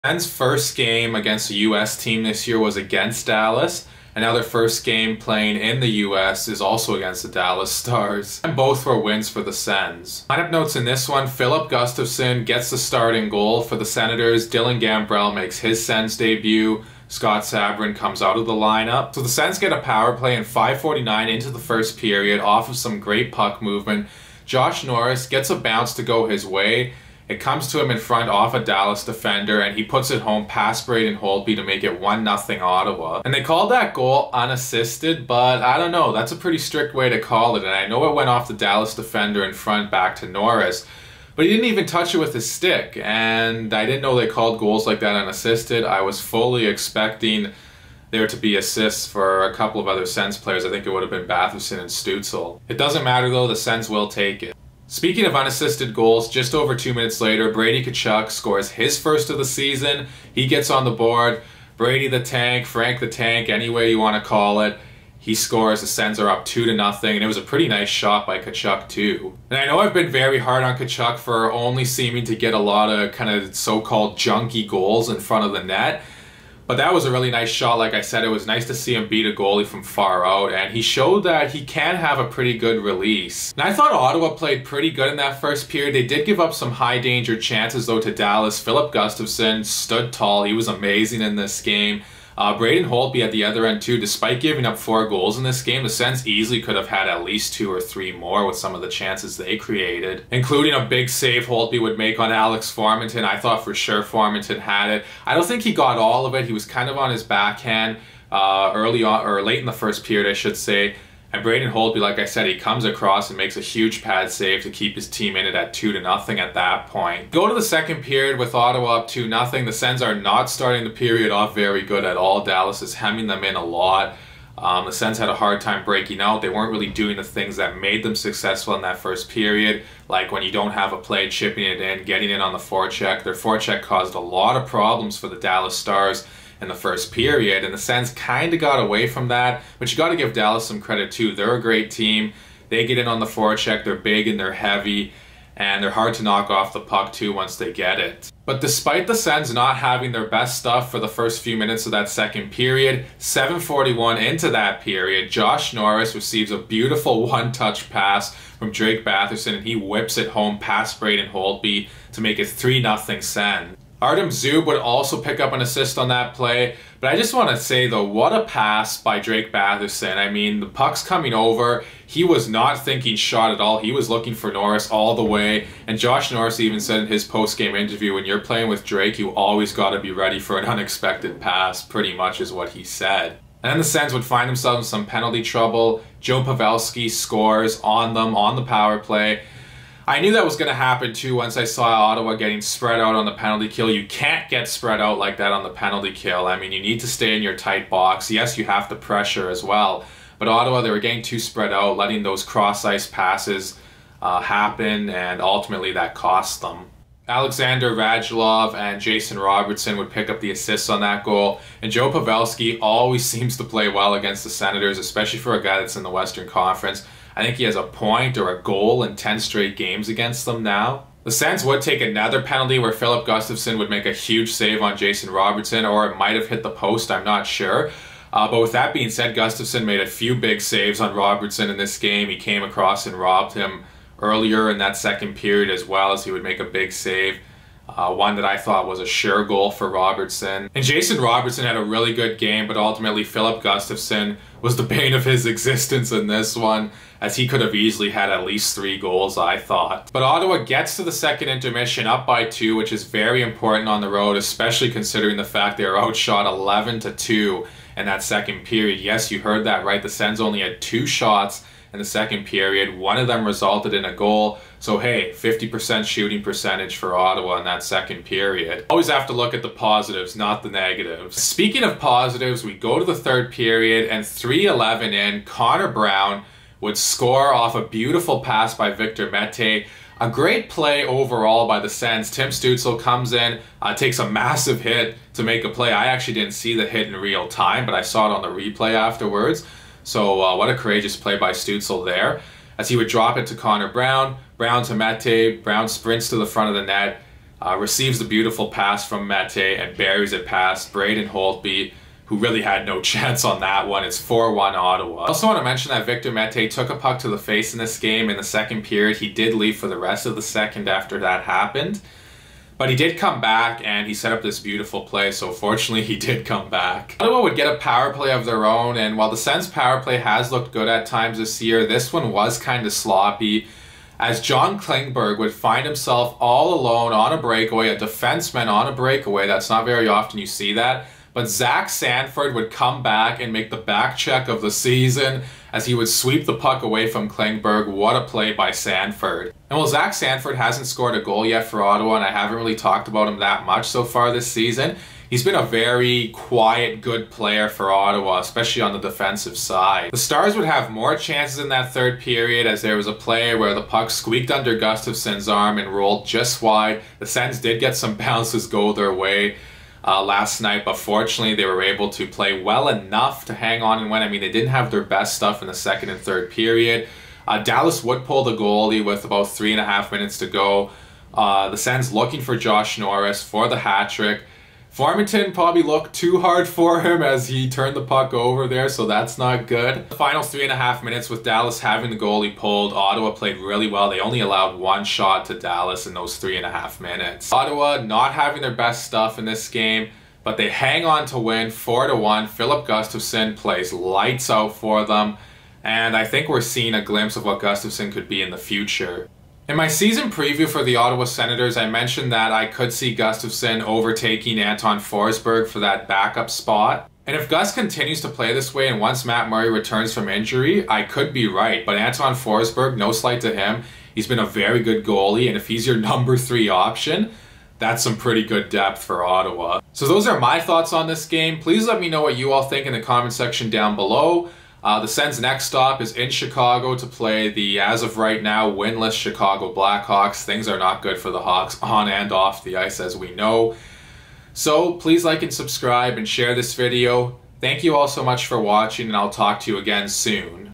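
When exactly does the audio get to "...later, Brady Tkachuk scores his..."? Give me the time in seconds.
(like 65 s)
57 s.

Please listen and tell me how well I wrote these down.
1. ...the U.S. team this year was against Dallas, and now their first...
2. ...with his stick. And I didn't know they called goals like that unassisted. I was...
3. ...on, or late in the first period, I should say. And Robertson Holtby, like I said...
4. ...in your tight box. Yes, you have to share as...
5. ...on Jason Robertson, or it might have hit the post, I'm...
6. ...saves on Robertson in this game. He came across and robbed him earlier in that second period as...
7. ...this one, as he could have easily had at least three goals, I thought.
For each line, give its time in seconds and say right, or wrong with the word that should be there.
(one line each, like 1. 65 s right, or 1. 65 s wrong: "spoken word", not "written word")
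1. 1 s right
2. 42 s right
3. 109 s wrong: "Braden", not "Robertson"
4. 197 s wrong: "pressure", not "share"
5. 224 s right
6. 230 s right
7. 246 s right.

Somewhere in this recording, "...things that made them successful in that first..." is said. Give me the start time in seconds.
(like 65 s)
127 s.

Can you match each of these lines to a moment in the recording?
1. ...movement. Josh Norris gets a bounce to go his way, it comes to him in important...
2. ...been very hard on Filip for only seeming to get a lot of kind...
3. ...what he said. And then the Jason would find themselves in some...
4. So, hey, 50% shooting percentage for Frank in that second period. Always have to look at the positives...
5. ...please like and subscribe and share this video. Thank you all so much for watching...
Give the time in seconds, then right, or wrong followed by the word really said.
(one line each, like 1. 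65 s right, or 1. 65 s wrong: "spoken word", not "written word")
1. 23 s wrong: "front", not "important"
2. 69 s wrong: "Tkachuk", not "Filip"
3. 182 s wrong: "Sens", not "Jason"
4. 264 s wrong: "Ottawa", not "Frank"
5. 434 s right.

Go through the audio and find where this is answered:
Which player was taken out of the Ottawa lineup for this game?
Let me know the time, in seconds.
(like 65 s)
17 s.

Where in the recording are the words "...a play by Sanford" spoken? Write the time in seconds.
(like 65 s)
338 s.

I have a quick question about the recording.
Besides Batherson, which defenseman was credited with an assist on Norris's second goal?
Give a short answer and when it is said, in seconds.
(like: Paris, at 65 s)
Artem Zub, at 164 s.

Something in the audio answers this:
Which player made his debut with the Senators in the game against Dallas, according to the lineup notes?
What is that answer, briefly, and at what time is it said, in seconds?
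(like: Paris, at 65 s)
Dylan Gambrell, at 14 s.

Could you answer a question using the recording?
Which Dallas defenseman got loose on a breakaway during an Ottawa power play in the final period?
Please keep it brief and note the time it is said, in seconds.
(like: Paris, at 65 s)
John Klingberg, at 324 s.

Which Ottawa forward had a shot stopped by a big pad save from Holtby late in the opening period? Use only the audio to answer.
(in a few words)
Alex Farmington.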